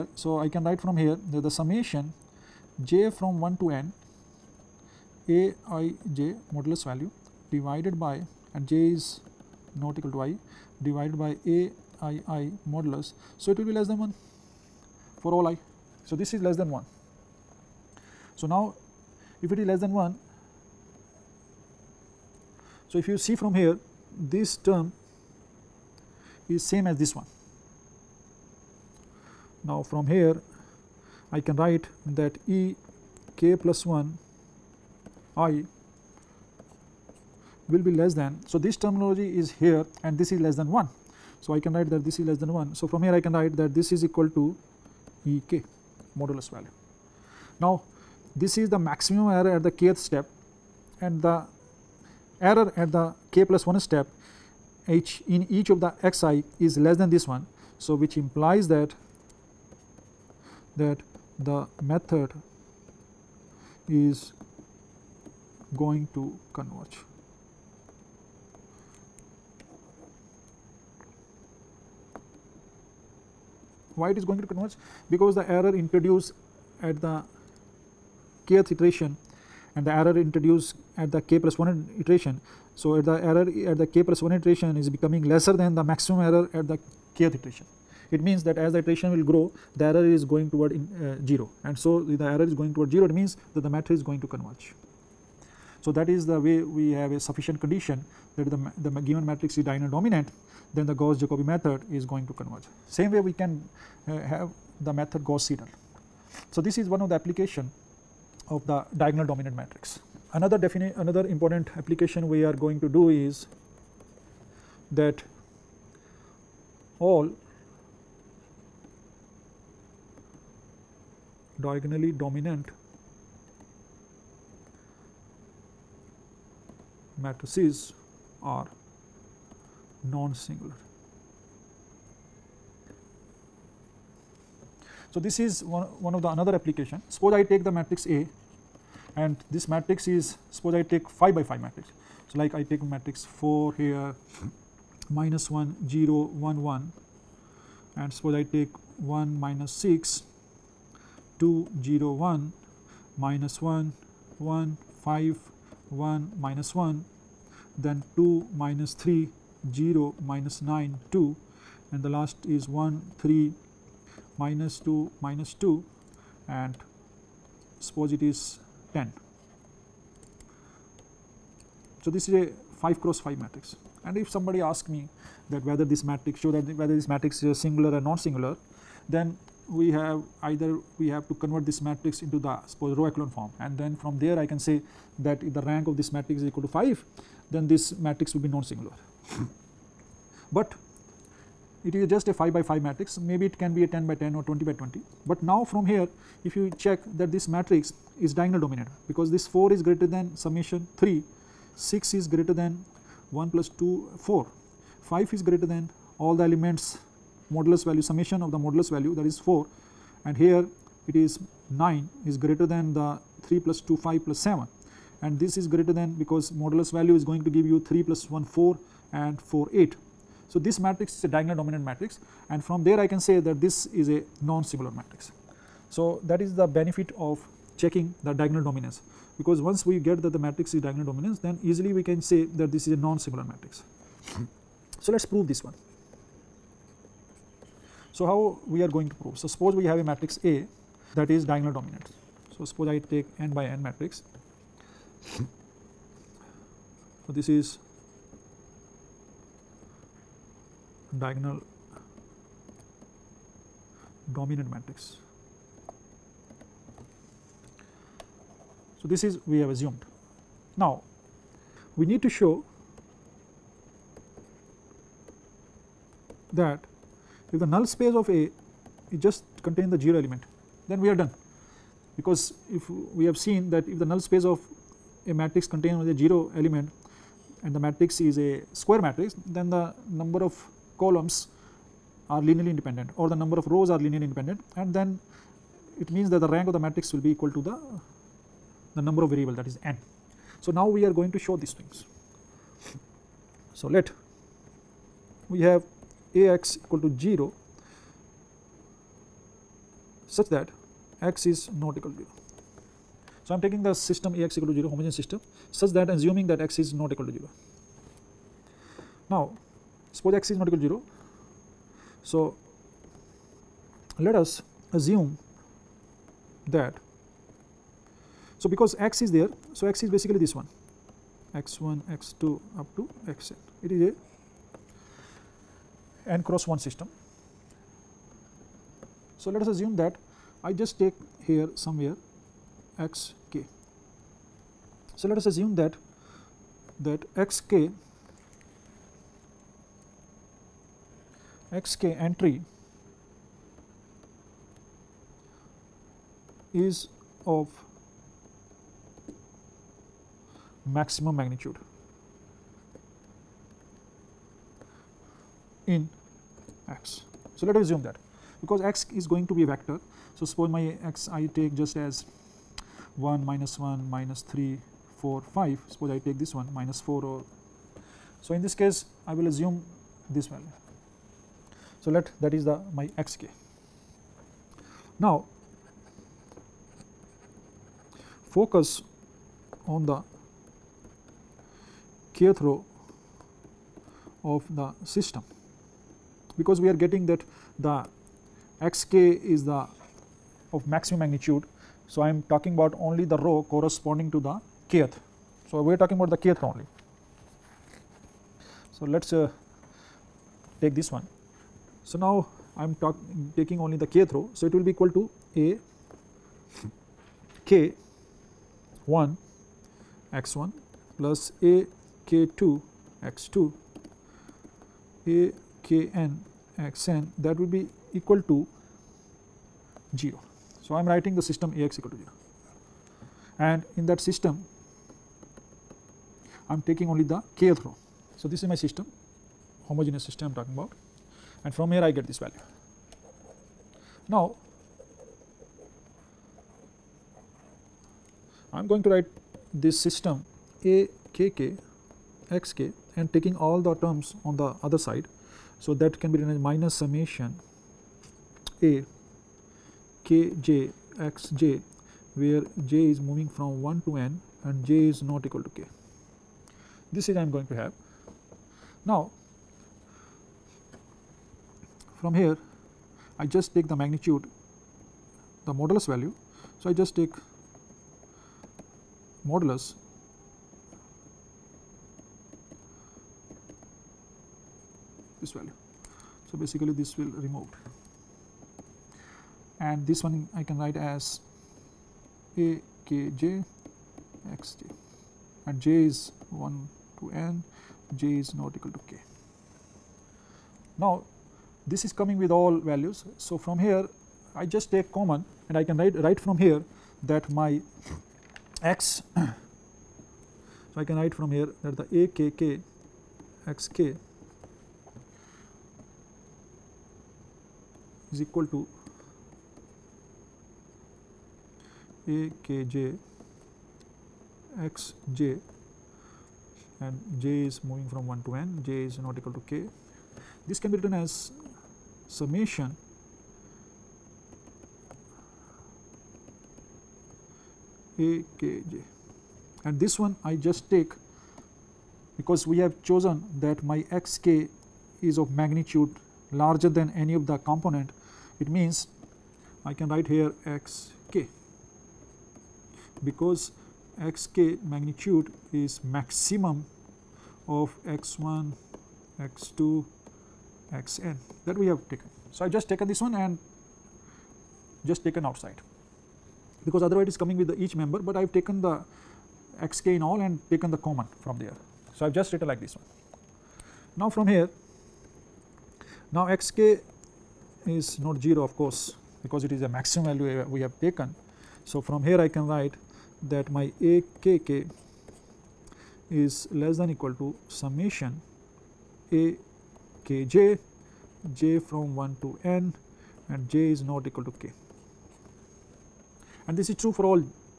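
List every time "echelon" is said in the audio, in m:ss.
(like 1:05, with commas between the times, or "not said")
3:03.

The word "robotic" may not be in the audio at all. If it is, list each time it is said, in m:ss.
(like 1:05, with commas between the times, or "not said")
not said.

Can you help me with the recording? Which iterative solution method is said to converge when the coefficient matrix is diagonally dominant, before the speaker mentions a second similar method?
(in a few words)
Gauss Jacobi.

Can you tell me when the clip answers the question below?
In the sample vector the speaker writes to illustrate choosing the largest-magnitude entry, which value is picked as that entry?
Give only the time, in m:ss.
6:06.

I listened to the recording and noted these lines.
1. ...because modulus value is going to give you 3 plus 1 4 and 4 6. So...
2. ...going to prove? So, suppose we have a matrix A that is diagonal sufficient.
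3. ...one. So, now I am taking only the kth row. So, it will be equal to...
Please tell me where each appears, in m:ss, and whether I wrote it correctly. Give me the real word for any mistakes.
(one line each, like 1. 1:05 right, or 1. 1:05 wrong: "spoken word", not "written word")
1. 3:36 wrong: "8", not "6"
2. 3:58 wrong: "dominant", not "sufficient"
3. 6:41 right.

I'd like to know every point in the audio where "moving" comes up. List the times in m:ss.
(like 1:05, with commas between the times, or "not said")
7:33, 8:37.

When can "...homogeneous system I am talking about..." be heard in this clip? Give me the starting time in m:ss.
7:09.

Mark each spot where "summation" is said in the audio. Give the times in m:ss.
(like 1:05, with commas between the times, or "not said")
0:01, 3:20, 3:28, 7:26, 8:42, 9:37.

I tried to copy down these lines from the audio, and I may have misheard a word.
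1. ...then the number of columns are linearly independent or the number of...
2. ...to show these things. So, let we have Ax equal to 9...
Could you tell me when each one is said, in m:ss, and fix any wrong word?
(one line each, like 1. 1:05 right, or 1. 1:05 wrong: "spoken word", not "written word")
1. 4:39 right
2. 4:51 wrong: "0", not "9".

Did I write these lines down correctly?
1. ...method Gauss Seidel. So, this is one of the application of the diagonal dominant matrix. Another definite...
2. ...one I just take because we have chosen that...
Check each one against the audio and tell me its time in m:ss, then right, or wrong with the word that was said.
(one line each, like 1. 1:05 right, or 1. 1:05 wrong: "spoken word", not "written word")
1. 1:44 right
2. 8:50 right.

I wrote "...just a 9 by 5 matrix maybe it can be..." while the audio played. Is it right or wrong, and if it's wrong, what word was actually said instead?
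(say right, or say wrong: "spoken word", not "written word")
wrong: "5", not "9".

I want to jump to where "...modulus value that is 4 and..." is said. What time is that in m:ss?
3:28.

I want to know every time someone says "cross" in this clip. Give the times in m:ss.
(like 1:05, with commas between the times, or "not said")
2:52, 5:26.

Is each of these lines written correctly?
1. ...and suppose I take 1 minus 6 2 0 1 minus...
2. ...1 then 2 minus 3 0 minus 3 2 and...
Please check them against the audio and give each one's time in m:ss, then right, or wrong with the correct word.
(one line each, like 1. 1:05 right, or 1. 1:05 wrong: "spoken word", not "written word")
1. 2:27 right
2. 2:36 wrong: "9", not "3".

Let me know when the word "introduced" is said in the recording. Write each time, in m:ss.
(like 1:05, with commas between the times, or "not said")
1:15, 1:20.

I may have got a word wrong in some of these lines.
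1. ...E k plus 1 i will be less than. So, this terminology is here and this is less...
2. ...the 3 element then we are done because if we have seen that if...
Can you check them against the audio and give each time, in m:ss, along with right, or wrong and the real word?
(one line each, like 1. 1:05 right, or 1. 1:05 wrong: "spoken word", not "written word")
1. 0:32 right
2. 4:29 wrong: "0", not "3".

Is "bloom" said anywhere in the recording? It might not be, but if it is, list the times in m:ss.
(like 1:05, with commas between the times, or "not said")
not said.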